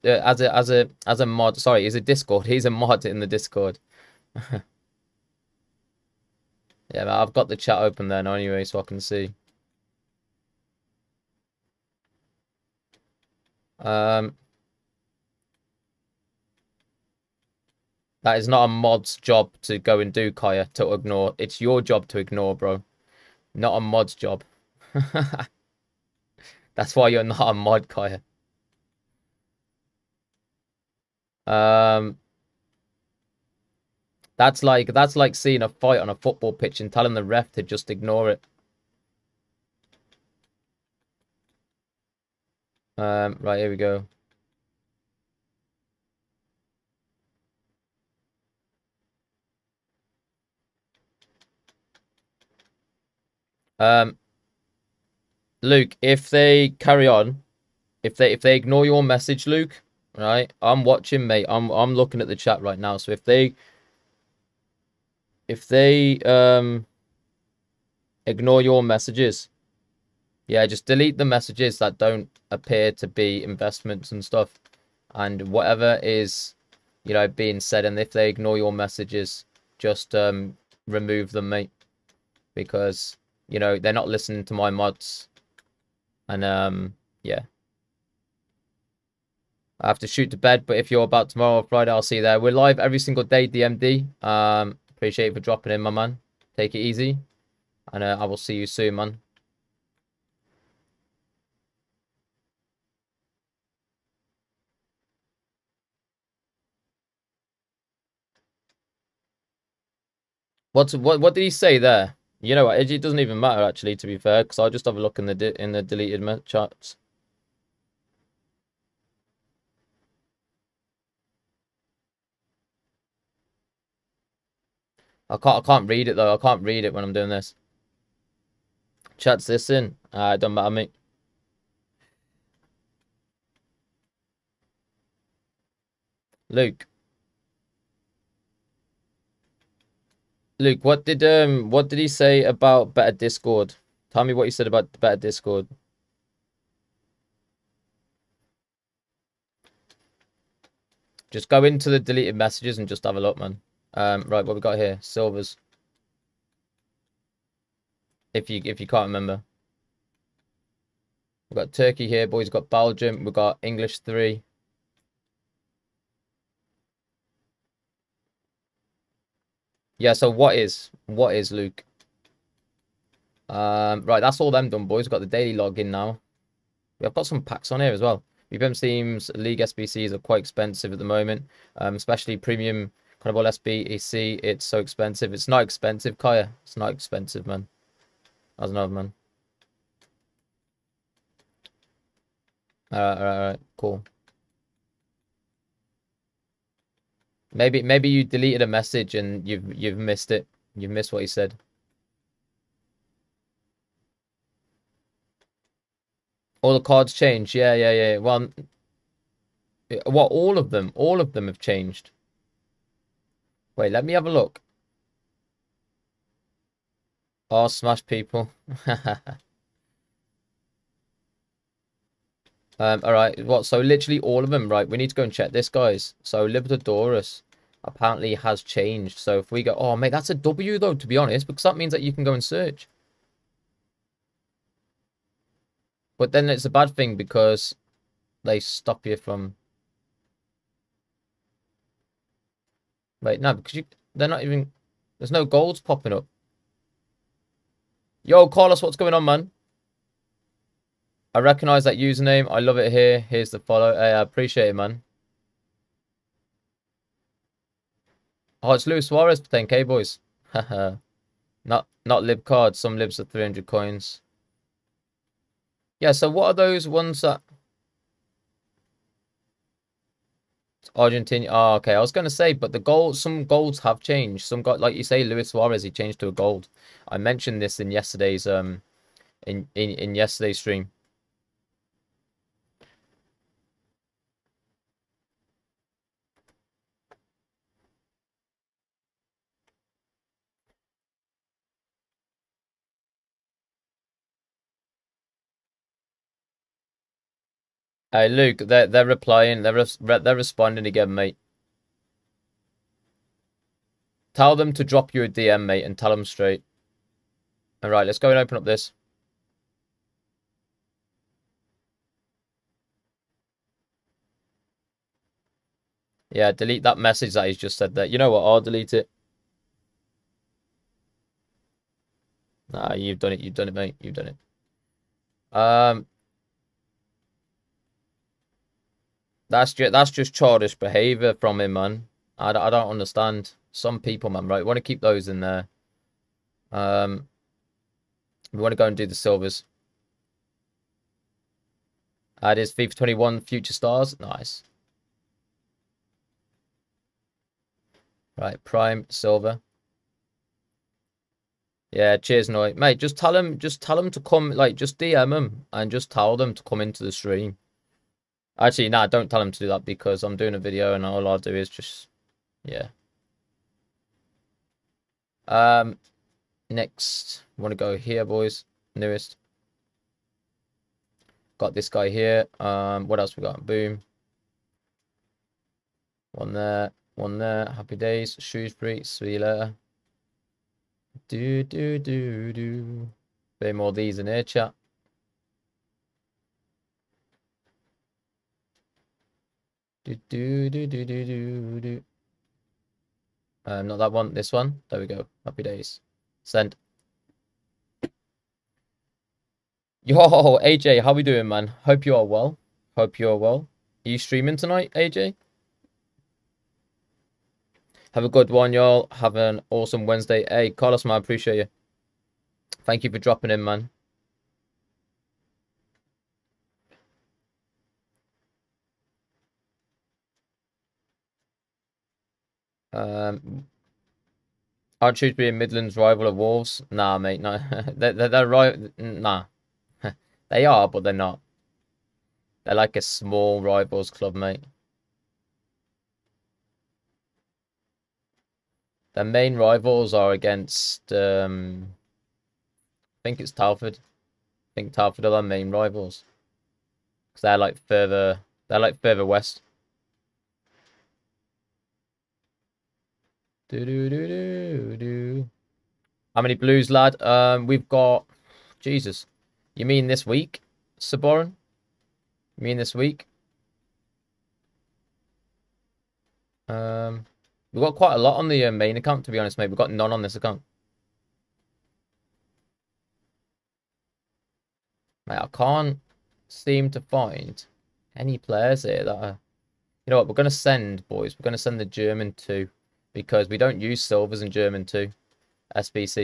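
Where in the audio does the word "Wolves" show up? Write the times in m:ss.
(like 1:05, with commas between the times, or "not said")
7:06.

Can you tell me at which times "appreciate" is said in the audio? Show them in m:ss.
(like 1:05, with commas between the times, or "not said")
1:34, 4:14, 6:51.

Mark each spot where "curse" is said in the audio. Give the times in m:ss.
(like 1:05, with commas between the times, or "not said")
not said.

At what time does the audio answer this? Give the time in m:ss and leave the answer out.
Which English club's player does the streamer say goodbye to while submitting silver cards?
6:18.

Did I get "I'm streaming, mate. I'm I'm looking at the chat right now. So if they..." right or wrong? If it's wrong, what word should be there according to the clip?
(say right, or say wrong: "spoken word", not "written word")
wrong: "watching", not "streaming".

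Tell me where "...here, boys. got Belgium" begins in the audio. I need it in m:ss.
2:42.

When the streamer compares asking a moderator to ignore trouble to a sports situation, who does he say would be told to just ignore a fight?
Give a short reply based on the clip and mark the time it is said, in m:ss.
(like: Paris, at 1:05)
the ref, at 0:37.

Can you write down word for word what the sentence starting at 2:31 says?
Just go into the deleted messages and just have a look, man.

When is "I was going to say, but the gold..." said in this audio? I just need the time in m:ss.
4:31.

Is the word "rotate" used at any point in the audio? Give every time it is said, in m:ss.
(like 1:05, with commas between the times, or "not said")
not said.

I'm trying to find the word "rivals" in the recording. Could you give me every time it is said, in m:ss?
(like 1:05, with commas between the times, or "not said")
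7:05, 7:13, 7:19, 7:25.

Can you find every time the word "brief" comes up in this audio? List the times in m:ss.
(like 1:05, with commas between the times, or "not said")
not said.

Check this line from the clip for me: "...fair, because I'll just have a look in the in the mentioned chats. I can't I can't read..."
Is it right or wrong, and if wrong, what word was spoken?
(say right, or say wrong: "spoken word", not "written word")
wrong: "deleted", not "mentioned".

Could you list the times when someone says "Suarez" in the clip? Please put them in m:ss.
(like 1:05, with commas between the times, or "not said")
4:19, 4:35.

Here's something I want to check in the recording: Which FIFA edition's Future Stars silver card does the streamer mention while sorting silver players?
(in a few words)
FIFA 21.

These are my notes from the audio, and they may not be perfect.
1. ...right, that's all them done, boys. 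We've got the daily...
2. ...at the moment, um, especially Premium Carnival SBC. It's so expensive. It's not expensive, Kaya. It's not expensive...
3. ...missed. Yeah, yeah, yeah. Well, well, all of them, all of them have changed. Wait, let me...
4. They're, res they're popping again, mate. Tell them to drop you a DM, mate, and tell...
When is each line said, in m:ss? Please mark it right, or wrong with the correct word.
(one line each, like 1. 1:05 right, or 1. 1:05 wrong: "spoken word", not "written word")
1. 2:54 right
2. 3:00 right
3. 3:27 wrong: "changed", not "missed"
4. 4:59 wrong: "responding", not "popping".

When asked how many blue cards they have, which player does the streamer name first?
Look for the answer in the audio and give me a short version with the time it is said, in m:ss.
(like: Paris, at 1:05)
Jesus, at 7:38.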